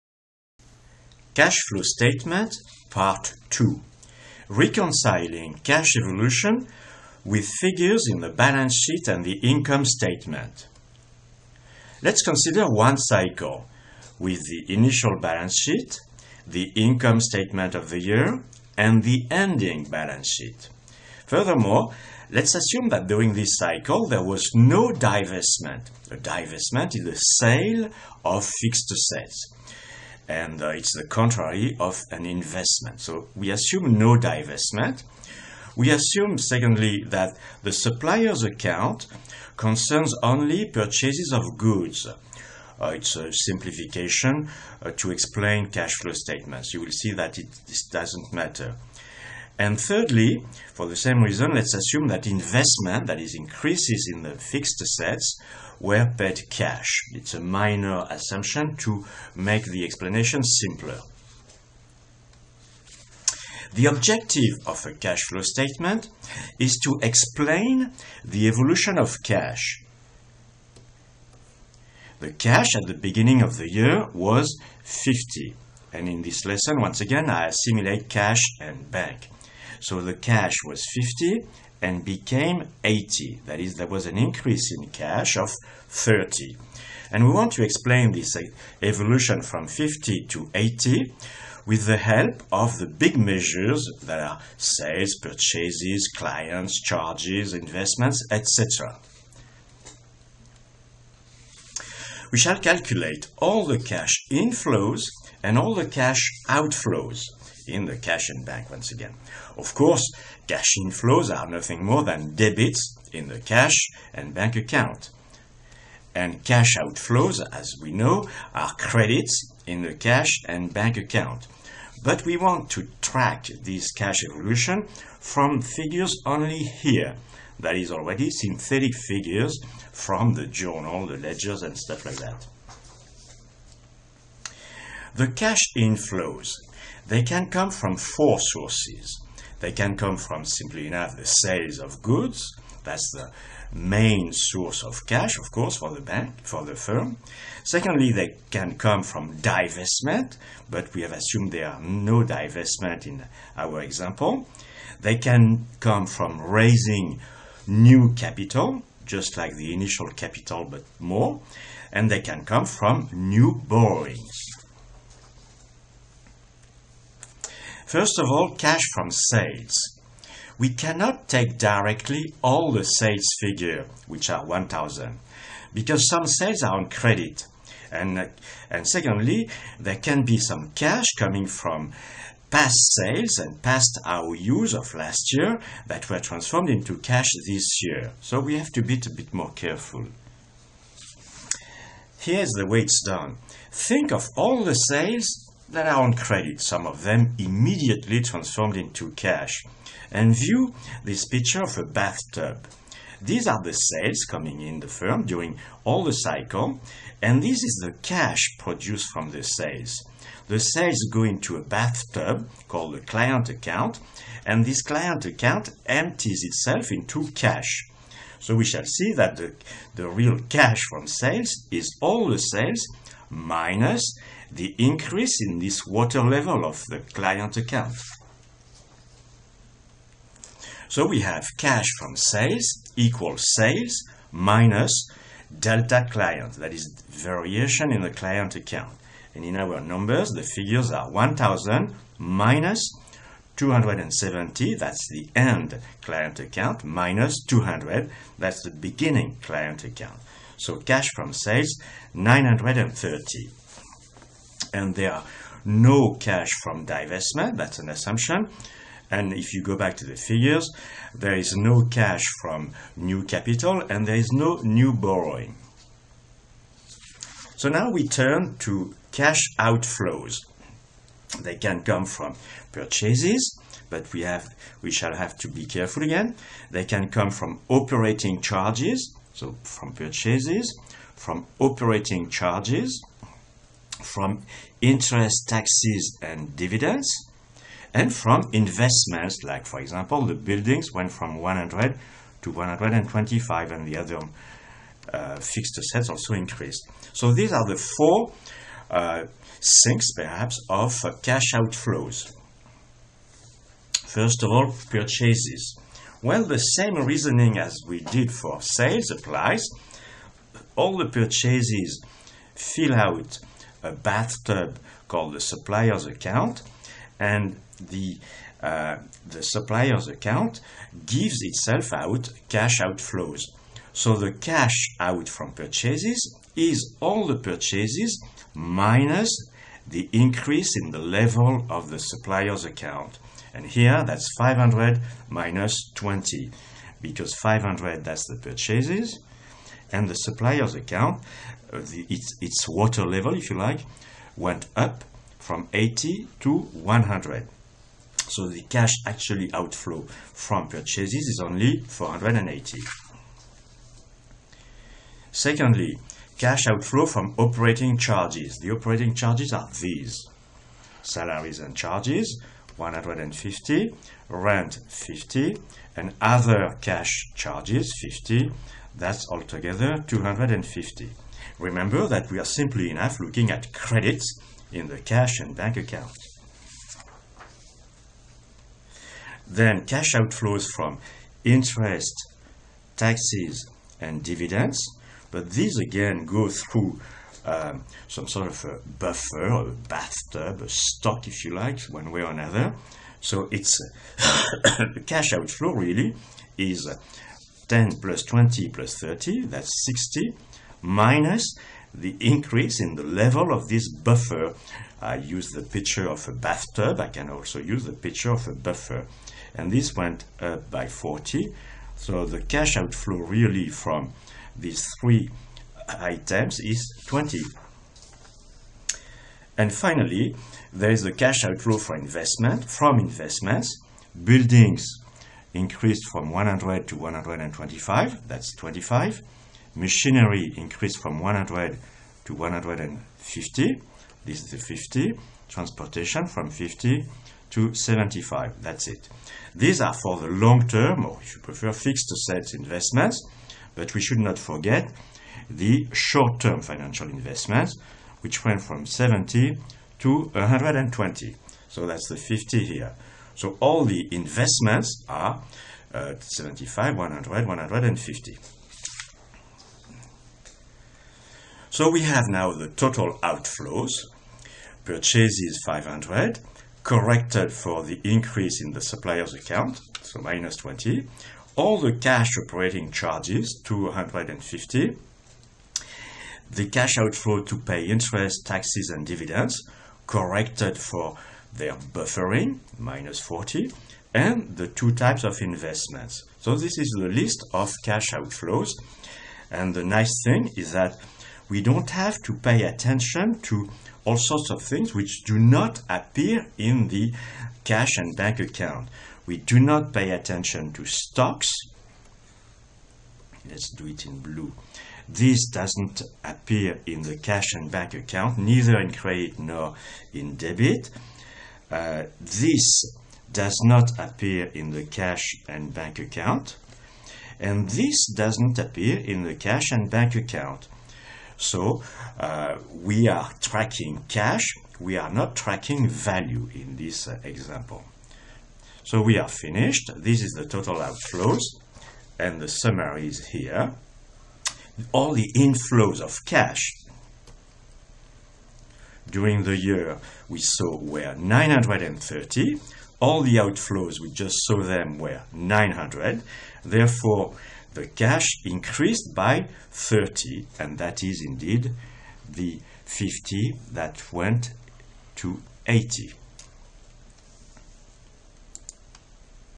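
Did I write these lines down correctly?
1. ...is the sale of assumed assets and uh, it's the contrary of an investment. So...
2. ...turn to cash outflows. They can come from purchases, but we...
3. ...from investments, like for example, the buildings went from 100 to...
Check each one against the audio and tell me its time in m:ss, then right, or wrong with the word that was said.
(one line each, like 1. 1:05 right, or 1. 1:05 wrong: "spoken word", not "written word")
1. 0:26 wrong: "fixed", not "assumed"
2. 4:28 right
3. 4:48 right.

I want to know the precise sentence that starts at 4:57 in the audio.
So these are the four uh, sinks, perhaps, of uh, cash outflows.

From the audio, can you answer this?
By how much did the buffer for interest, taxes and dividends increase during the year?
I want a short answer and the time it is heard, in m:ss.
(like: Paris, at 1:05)
40, at 6:49.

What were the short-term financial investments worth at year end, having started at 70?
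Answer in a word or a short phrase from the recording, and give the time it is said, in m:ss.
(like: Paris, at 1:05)
120, at 7:28.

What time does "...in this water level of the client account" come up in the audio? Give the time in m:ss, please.
3:45.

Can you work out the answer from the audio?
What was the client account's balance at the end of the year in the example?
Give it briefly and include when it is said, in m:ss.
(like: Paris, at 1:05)
270, at 4:03.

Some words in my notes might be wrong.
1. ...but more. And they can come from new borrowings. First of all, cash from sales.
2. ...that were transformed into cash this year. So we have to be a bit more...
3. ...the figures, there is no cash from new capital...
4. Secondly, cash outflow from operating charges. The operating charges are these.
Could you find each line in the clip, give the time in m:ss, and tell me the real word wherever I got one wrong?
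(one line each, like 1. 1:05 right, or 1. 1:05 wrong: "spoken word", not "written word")
1. 2:40 right
2. 3:05 right
3. 4:20 right
4. 5:55 right.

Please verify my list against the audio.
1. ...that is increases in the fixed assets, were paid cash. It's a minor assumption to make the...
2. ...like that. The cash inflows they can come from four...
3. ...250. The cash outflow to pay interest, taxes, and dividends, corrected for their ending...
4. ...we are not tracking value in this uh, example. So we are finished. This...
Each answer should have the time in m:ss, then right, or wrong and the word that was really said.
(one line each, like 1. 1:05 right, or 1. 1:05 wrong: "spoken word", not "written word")
1. 0:53 right
2. 2:12 right
3. 7:53 wrong: "buffering", not "ending"
4. 8:44 right.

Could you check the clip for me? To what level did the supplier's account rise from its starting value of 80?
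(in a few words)
100.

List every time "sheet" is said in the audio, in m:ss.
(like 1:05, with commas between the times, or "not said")
0:08, 0:15, 0:20.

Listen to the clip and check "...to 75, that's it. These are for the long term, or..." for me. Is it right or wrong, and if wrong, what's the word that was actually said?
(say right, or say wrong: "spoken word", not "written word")
right.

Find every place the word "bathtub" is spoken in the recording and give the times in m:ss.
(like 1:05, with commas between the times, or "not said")
3:21, 3:31, 5:13, 6:29, 6:46.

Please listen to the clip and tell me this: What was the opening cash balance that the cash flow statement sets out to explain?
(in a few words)
50.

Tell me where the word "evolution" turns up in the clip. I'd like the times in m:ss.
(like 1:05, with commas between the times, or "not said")
0:05, 1:08, 1:28, 2:04.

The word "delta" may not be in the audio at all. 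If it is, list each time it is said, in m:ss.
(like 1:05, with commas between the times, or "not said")
3:55.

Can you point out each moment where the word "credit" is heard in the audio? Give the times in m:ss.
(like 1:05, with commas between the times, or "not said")
1:58, 2:56, 3:16, 6:13, 8:28.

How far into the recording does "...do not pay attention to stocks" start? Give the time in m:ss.
8:19.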